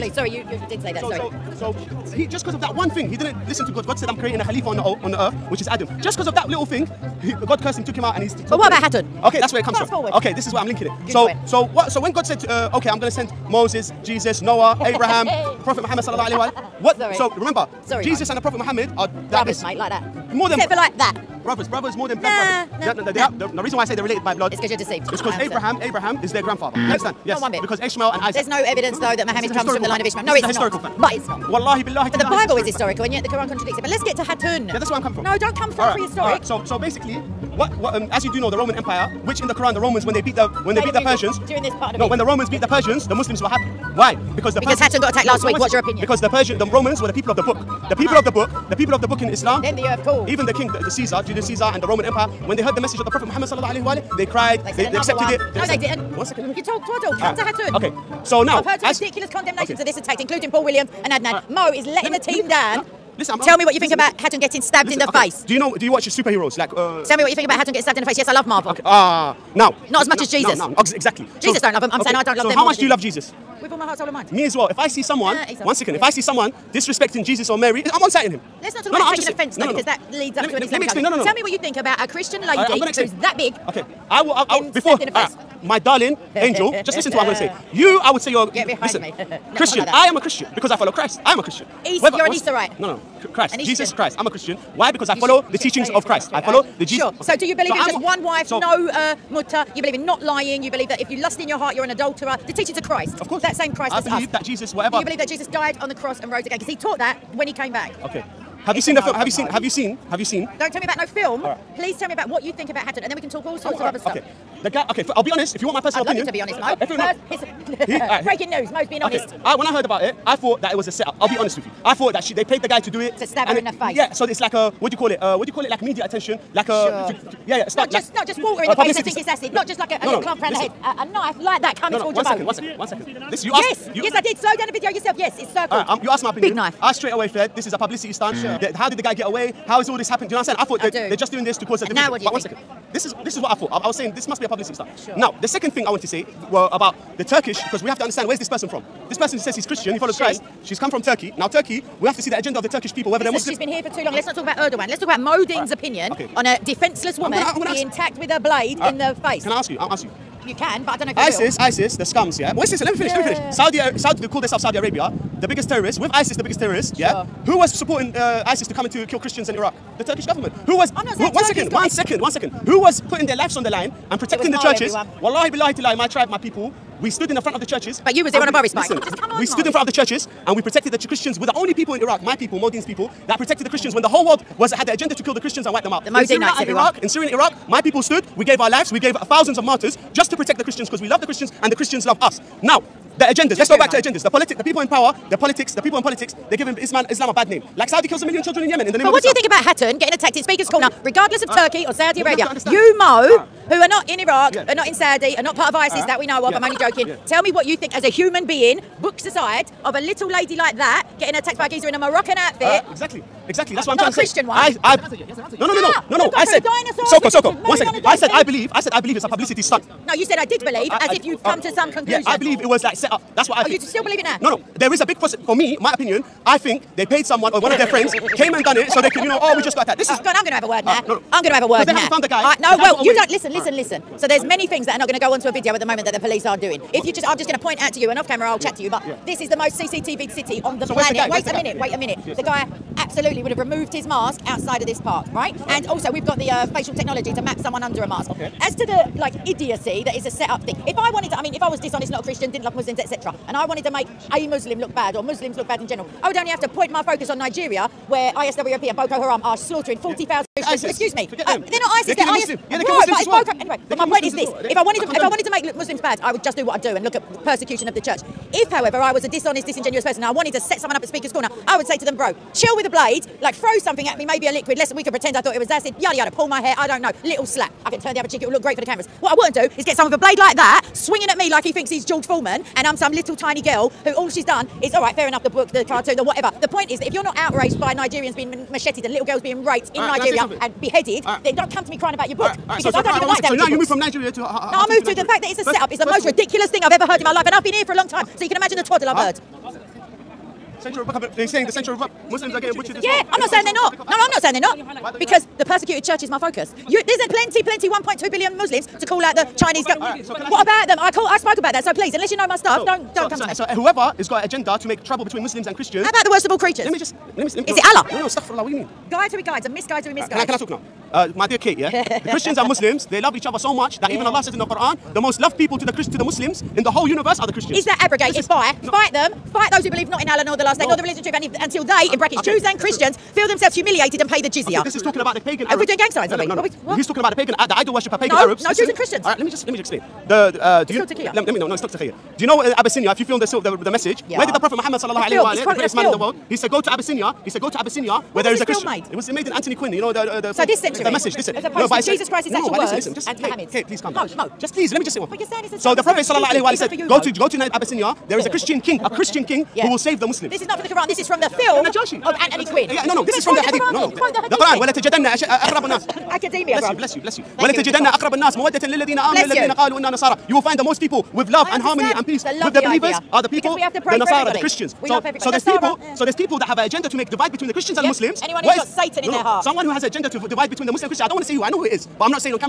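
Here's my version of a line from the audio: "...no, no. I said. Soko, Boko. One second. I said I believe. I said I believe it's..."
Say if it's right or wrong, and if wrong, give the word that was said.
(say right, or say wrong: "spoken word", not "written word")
wrong: "Soko", not "Boko".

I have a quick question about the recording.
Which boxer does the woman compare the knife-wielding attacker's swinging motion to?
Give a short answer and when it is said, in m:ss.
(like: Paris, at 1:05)
George Foreman, at 4:42.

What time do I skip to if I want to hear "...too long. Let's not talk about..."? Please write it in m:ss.
2:33.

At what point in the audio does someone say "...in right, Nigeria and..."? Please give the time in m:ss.
4:49.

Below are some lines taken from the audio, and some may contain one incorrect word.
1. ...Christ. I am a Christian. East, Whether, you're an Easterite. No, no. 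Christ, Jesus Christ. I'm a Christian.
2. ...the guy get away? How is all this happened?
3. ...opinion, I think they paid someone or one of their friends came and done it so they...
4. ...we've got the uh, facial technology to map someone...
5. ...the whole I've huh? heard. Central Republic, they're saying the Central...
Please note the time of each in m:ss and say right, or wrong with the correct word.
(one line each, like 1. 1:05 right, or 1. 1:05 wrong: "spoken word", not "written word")
1. 1:30 right
2. 2:18 right
3. 3:45 right
4. 4:06 right
5. 4:58 wrong: "twaddle", not "whole".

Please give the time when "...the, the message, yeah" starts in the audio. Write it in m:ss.
5:43.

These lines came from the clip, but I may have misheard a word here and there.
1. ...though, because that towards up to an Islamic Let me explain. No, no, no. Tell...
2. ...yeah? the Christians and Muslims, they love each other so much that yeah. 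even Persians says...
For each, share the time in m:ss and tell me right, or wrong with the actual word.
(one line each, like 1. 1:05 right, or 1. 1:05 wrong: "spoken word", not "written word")
1. 1:19 wrong: "leads", not "towards"
2. 5:21 wrong: "Allah", not "Persians".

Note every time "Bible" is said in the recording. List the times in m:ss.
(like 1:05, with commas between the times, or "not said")
0:32.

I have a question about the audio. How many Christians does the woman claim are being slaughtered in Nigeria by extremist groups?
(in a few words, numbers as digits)
40,000.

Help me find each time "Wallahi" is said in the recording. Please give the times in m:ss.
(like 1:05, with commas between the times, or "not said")
0:31, 2:55.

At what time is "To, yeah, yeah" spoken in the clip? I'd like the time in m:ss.
2:07.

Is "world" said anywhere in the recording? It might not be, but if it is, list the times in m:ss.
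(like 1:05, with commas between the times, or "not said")
3:04, 5:46.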